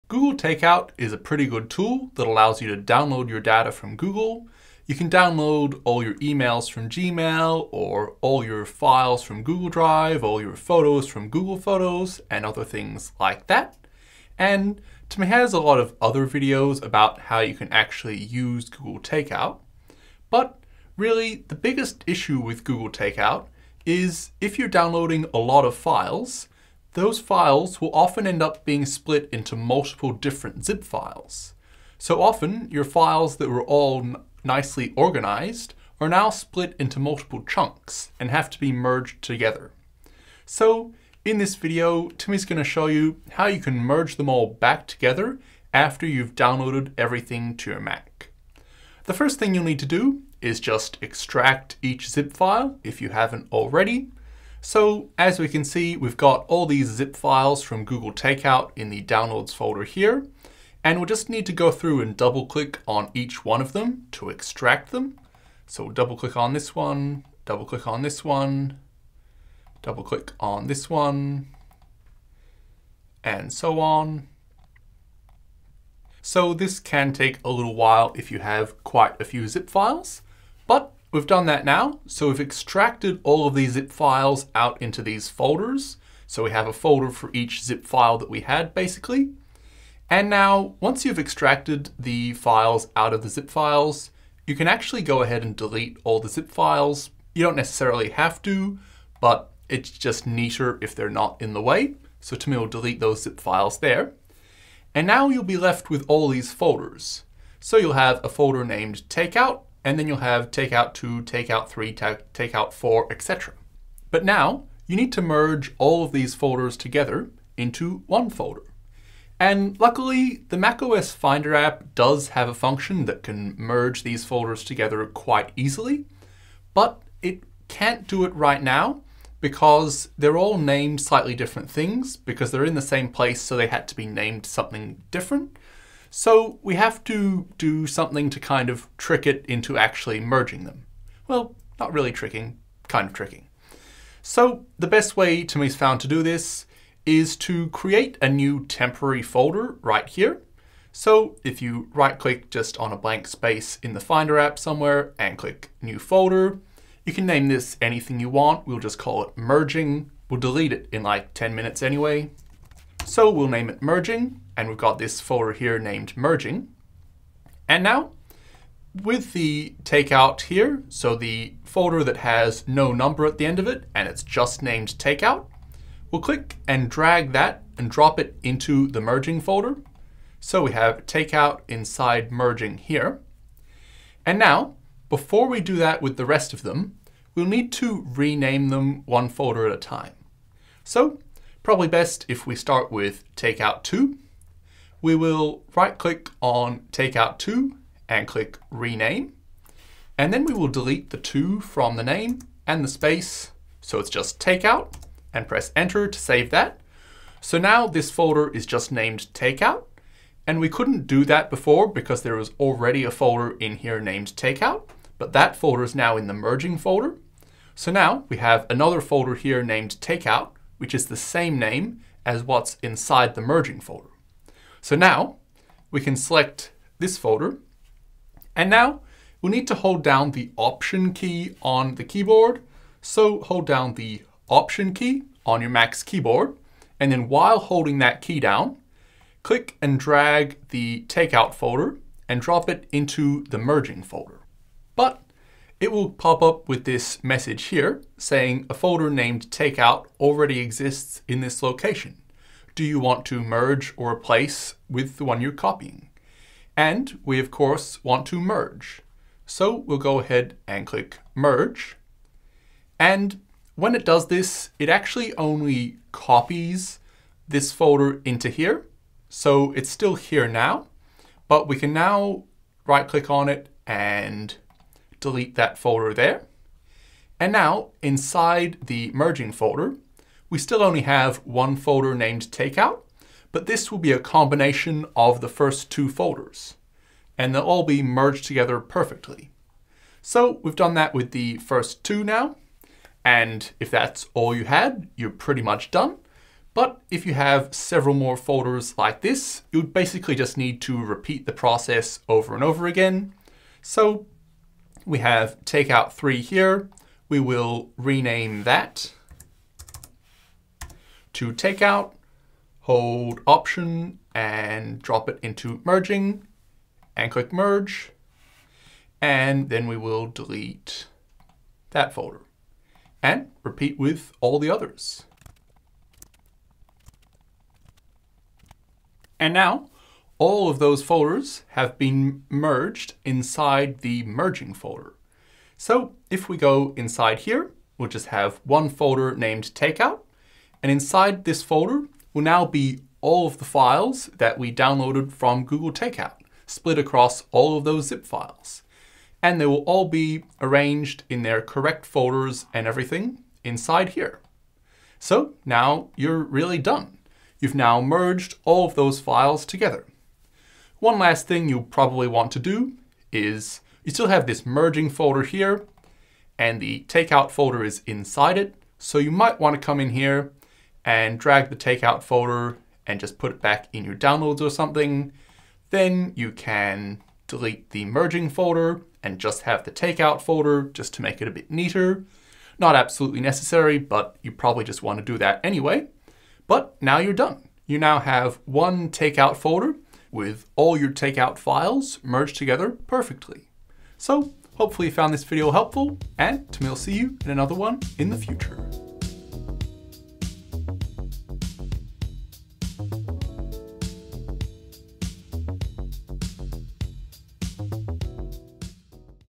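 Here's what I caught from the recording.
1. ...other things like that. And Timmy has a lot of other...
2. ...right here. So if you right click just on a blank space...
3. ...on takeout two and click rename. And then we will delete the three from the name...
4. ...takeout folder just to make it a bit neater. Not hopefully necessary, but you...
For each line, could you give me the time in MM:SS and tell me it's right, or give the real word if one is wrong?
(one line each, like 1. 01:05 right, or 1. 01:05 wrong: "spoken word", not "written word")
1. 00:12 right
2. 02:29 right
3. 03:16 wrong: "two", not "three"
4. 06:19 wrong: "absolutely", not "hopefully".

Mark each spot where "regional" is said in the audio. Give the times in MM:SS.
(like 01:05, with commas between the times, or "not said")
not said.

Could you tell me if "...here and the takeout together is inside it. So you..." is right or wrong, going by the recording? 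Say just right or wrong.
wrong.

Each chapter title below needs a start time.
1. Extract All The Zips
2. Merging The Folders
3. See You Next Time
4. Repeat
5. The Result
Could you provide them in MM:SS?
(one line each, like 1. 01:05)
1. 00:55
2. 01:54
3. 06:27
4. 04:50
5. 05:29.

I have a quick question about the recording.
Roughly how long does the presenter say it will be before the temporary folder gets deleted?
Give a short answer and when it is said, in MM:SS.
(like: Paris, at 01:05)
10 minutes, at 02:41.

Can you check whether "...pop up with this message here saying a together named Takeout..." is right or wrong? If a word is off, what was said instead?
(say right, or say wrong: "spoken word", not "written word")
wrong: "folder", not "together".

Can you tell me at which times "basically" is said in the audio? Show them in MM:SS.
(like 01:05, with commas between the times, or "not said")
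01:28, 04:59.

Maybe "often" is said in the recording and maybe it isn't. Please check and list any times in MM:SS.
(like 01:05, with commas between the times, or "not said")
00:27, 00:32.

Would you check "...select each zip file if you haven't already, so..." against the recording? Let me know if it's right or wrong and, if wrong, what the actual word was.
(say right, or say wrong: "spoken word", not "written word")
wrong: "extract", not "select".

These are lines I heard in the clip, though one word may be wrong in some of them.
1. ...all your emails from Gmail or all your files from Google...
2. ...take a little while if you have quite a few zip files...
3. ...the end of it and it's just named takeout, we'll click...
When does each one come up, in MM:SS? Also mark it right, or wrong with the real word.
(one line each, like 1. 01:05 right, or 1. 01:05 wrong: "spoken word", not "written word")
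1. 00:05 right
2. 01:17 right
3. 02:53 right.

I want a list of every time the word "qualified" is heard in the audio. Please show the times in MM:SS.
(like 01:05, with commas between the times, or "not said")
not said.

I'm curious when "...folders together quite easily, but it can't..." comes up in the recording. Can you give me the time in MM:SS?
02:04.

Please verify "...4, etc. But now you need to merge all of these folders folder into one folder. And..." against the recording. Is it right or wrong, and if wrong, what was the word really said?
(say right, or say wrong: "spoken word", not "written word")
wrong: "together", not "folder".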